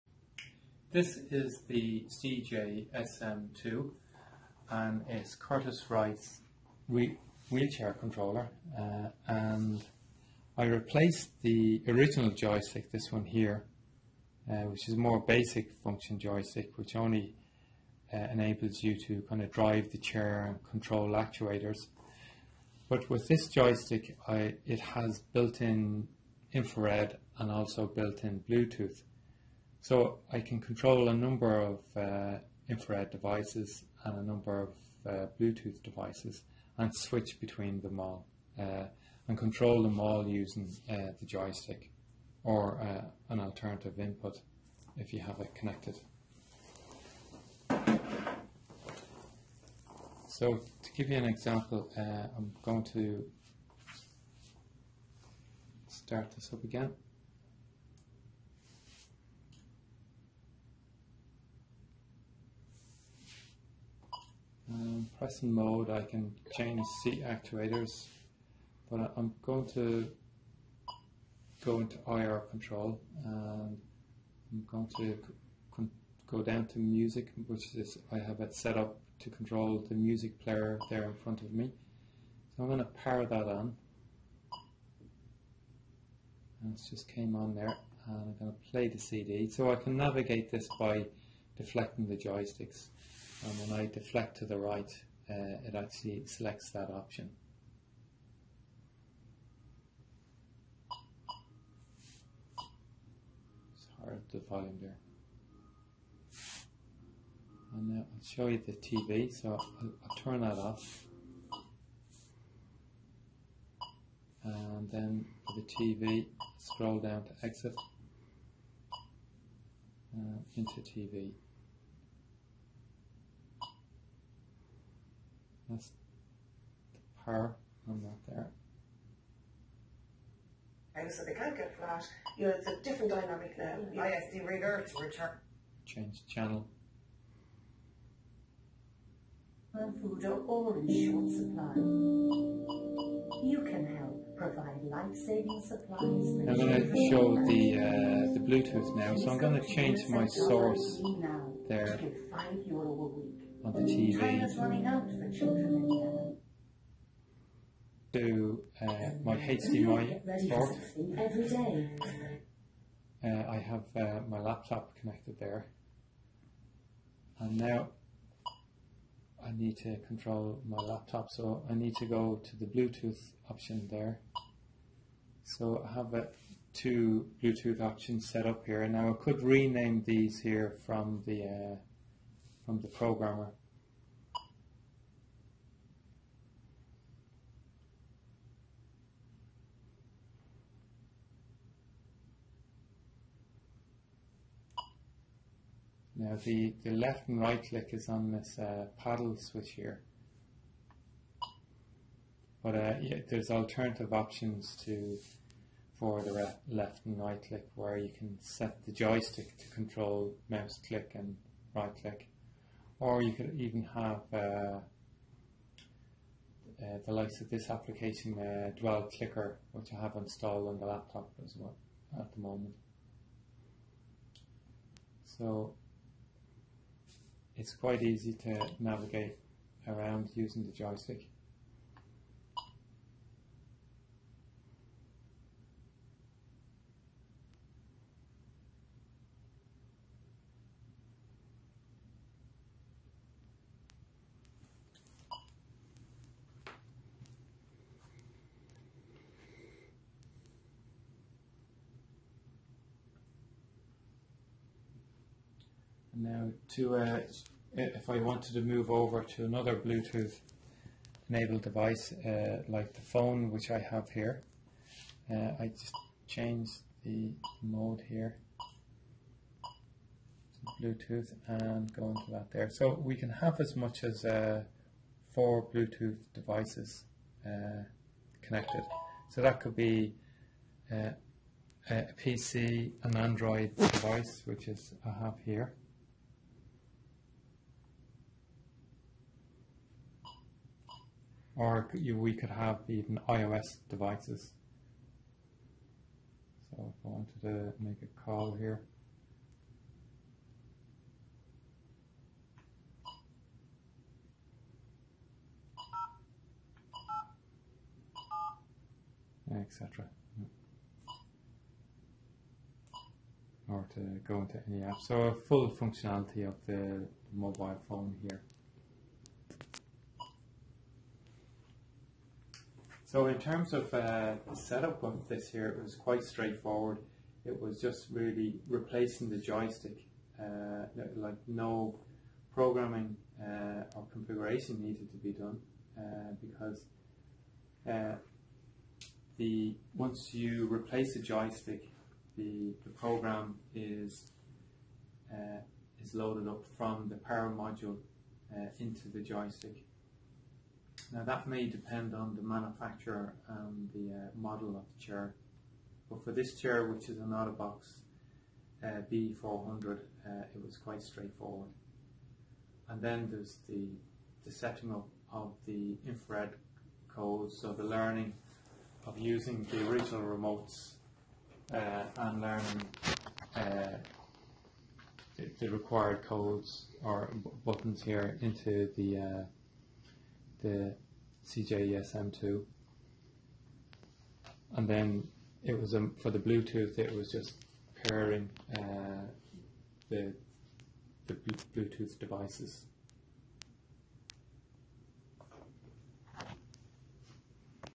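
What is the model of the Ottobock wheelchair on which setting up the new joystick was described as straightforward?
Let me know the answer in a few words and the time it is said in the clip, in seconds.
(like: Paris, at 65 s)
B400, at 359 s.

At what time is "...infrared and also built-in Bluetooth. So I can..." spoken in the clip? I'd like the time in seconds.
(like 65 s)
26 s.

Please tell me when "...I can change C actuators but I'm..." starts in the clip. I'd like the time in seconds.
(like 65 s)
65 s.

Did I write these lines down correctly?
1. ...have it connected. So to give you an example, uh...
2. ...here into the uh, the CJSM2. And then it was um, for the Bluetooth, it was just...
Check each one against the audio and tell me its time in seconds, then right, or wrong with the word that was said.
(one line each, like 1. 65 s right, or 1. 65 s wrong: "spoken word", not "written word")
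1. 45 s right
2. 378 s right.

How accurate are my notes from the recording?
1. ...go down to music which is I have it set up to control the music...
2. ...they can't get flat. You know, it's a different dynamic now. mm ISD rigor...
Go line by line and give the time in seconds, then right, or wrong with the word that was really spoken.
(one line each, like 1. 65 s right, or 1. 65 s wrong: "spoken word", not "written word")
1. 76 s right
2. 131 s right.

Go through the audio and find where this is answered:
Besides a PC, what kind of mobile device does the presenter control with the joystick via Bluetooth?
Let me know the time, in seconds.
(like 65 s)
283 s.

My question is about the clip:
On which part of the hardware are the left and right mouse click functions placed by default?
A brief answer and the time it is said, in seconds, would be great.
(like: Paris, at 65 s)
paddle switch, at 198 s.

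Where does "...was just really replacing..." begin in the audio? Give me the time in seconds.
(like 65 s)
327 s.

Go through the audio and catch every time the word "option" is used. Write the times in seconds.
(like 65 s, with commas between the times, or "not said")
96 s, 173 s, 177 s, 204 s.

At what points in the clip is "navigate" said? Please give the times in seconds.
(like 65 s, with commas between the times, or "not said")
89 s, 228 s.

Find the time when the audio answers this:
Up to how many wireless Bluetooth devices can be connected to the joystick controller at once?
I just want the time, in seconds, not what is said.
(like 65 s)
275 s.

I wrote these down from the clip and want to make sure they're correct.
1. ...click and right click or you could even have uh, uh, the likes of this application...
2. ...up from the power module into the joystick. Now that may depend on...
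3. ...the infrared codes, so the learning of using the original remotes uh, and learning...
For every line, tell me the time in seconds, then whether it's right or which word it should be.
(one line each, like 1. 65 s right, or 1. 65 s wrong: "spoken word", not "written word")
1. 210 s right
2. 346 s right
3. 365 s right.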